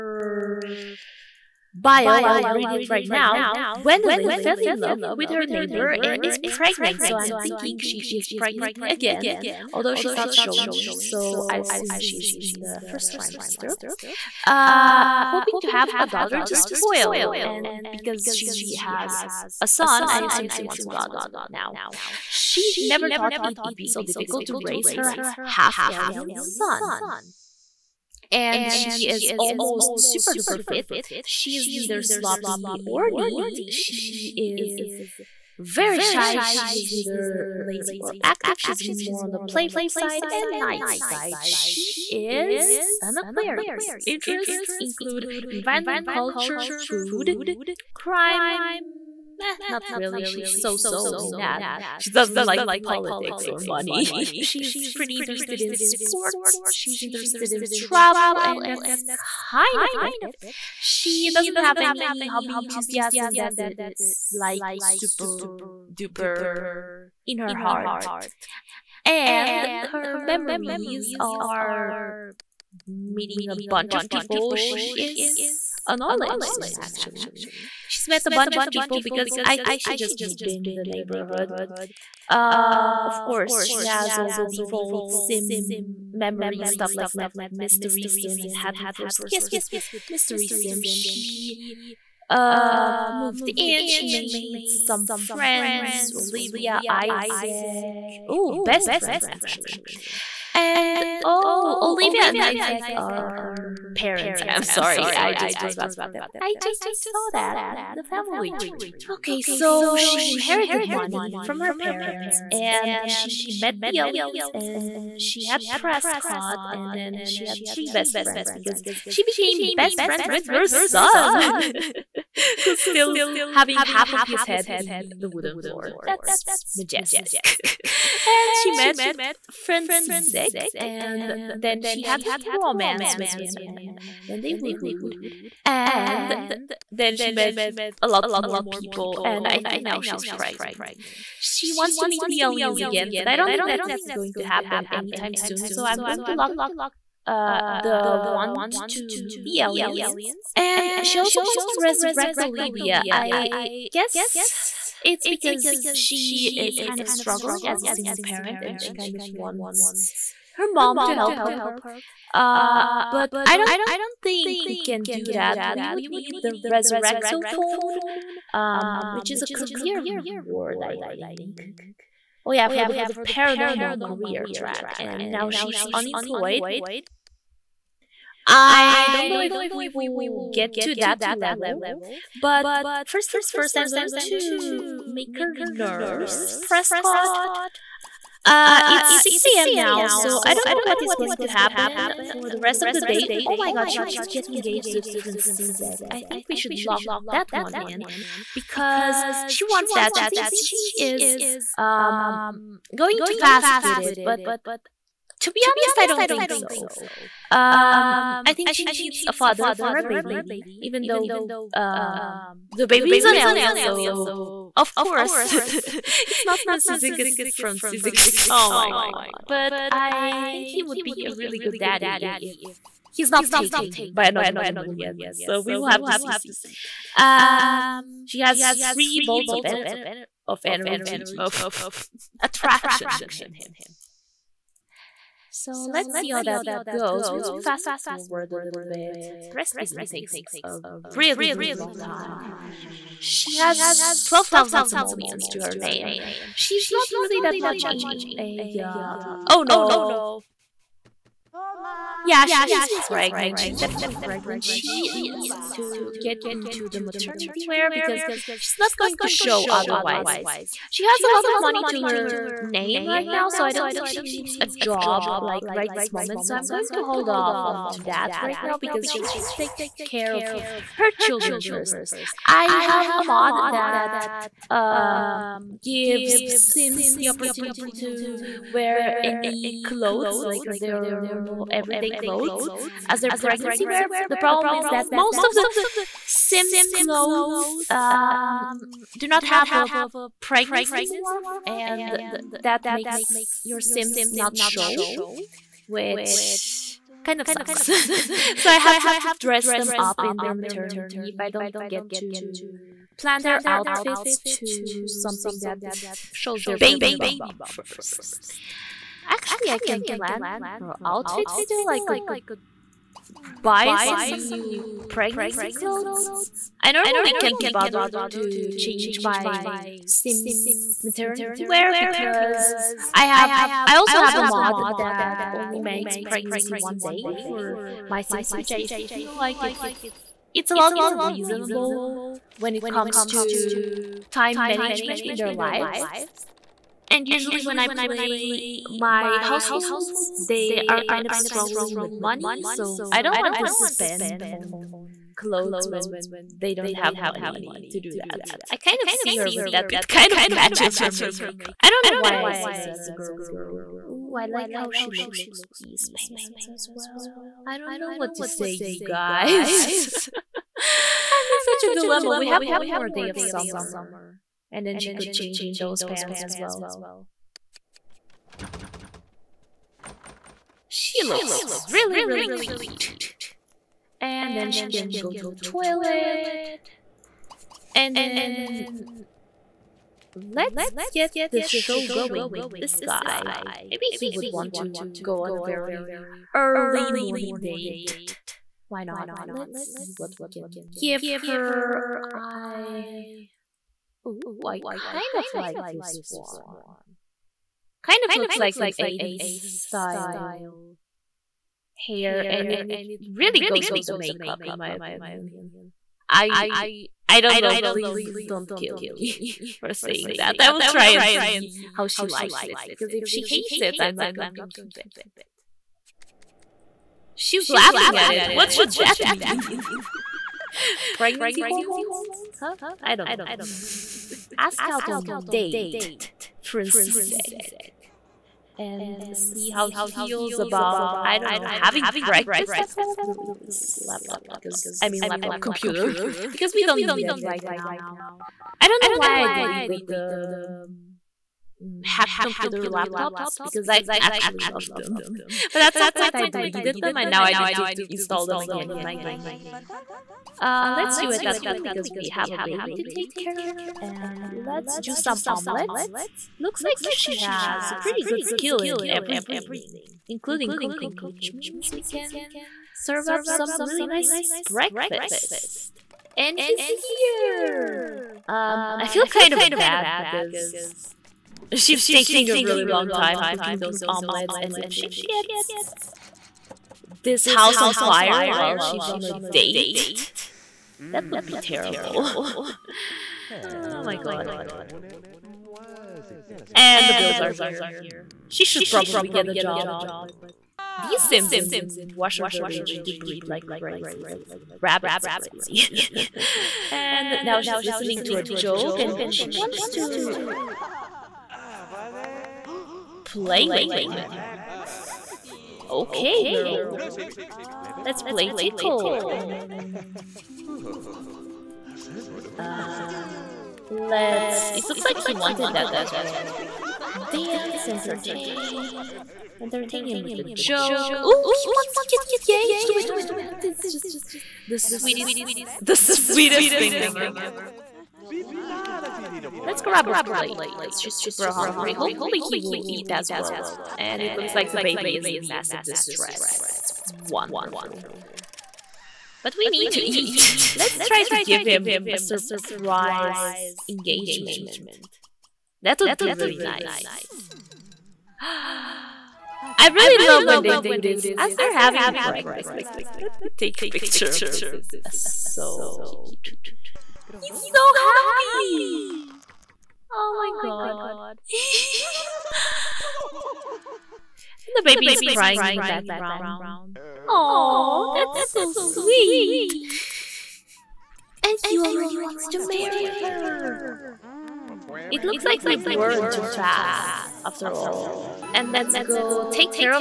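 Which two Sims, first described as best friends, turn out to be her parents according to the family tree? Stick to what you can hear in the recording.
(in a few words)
Olivia and Isaac.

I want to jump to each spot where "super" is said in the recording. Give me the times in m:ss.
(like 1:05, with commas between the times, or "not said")
0:29, 1:04, 8:51.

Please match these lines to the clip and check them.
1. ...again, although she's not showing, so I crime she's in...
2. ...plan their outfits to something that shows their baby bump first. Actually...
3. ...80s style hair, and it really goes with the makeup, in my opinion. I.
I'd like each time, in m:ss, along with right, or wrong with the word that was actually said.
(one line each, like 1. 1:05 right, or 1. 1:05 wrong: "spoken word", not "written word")
1. 0:08 wrong: "assume", not "crime"
2. 5:03 right
3. 6:38 right.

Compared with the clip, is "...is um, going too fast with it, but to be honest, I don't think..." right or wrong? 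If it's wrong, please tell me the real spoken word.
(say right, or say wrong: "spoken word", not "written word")
right.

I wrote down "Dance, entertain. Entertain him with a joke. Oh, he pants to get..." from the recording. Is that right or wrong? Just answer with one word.
wrong.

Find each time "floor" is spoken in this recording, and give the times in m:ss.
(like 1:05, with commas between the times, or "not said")
2:05.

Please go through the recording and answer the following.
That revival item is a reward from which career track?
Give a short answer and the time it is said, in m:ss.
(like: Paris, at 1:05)
paranormal, at 2:53.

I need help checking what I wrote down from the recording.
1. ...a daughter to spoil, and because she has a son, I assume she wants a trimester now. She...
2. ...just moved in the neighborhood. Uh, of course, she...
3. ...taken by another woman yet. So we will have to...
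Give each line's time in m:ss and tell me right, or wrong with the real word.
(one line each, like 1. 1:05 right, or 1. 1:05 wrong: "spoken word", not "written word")
1. 0:15 wrong: "daughter", not "trimester"
2. 1:19 right
3. 3:43 right.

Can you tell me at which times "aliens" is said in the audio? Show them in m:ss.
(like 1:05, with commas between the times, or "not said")
0:25, 1:53, 2:22, 2:29, 3:33.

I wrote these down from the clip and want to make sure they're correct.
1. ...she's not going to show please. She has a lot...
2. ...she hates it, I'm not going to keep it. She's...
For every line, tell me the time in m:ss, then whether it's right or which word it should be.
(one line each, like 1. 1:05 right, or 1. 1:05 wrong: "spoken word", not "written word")
1. 4:18 wrong: "otherwise", not "please"
2. 6:53 right.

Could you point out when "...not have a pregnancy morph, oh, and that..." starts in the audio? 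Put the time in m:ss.
4:49.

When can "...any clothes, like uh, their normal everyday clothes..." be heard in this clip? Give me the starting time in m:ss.
4:39.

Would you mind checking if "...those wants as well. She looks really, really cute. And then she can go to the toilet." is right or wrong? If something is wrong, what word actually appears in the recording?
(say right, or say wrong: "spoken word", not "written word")
wrong: "pants", not "wants".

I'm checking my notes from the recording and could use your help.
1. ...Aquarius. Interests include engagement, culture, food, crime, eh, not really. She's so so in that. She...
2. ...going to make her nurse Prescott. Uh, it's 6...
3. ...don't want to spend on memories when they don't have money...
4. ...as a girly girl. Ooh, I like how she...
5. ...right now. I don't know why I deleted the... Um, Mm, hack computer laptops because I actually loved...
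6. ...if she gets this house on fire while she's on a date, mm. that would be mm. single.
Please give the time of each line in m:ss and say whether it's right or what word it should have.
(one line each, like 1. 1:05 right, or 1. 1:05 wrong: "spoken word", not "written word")
1. 0:43 wrong: "environment", not "engagement"
2. 3:03 right
3. 5:43 wrong: "clothes", not "memories"
4. 5:52 right
5. 7:17 right
6. 7:54 wrong: "terrible", not "single".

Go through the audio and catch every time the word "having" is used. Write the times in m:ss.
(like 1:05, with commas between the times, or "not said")
2:03, 7:11, 9:11.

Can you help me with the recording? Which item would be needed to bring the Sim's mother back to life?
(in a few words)
Resurrecto phone.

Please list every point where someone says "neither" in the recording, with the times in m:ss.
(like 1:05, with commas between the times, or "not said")
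0:31, 0:36.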